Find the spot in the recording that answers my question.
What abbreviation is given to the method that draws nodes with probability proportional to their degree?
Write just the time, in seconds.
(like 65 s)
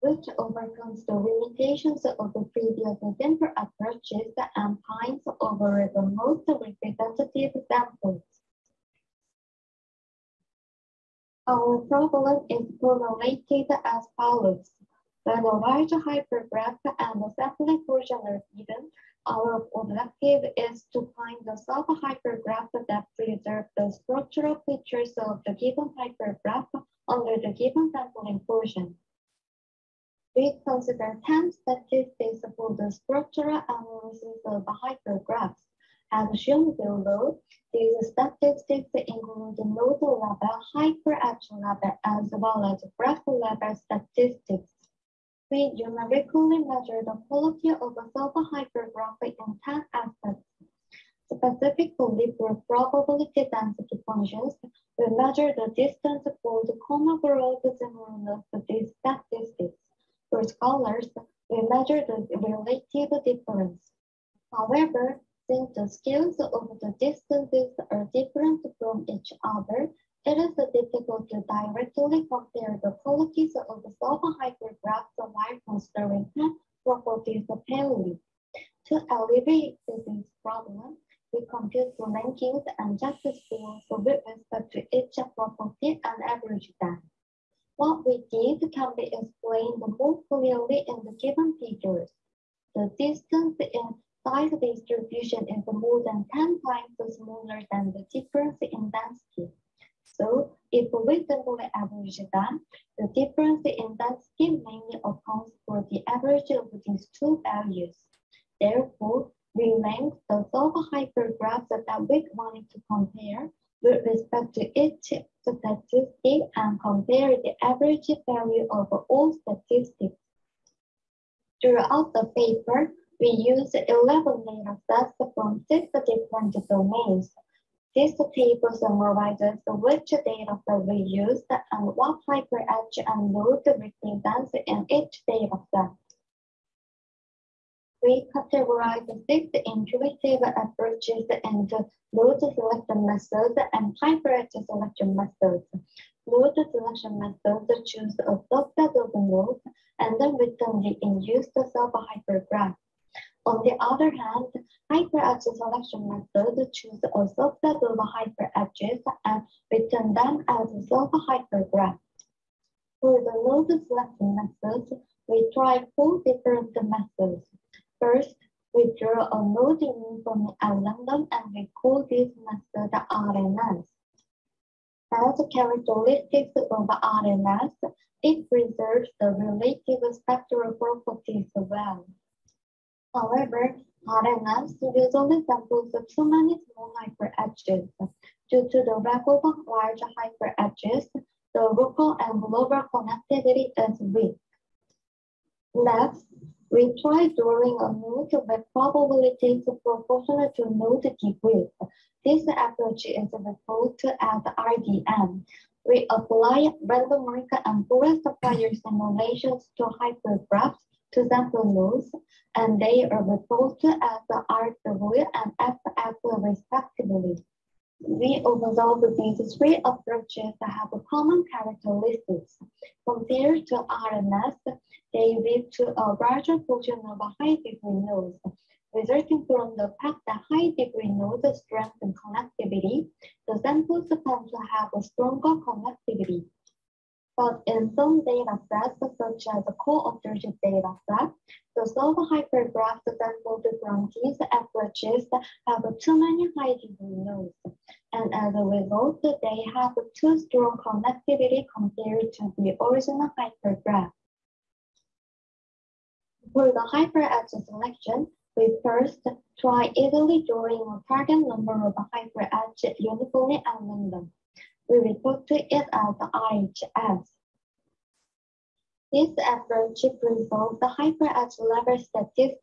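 204 s.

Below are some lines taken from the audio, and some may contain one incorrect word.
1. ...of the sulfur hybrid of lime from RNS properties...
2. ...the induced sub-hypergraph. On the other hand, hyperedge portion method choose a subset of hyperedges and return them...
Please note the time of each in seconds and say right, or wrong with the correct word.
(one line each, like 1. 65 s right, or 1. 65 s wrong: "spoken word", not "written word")
1. 73 s wrong: "Sri", not "RNS"
2. 150 s wrong: "selection", not "portion".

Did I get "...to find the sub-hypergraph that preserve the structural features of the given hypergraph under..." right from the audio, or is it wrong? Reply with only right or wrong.
right.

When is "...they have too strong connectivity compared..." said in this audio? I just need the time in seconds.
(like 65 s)
249 s.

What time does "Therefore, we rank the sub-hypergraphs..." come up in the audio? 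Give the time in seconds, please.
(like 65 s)
108 s.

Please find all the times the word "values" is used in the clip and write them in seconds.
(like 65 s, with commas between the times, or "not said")
107 s, 118 s.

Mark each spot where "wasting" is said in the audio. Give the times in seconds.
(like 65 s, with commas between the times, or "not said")
not said.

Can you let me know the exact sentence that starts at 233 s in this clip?
The sample to have a stronger connectivity.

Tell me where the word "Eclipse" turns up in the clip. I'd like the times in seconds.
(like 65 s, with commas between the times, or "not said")
not said.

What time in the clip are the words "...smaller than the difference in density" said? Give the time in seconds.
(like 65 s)
97 s.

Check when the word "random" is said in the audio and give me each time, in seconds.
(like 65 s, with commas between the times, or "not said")
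170 s, 206 s, 263 s.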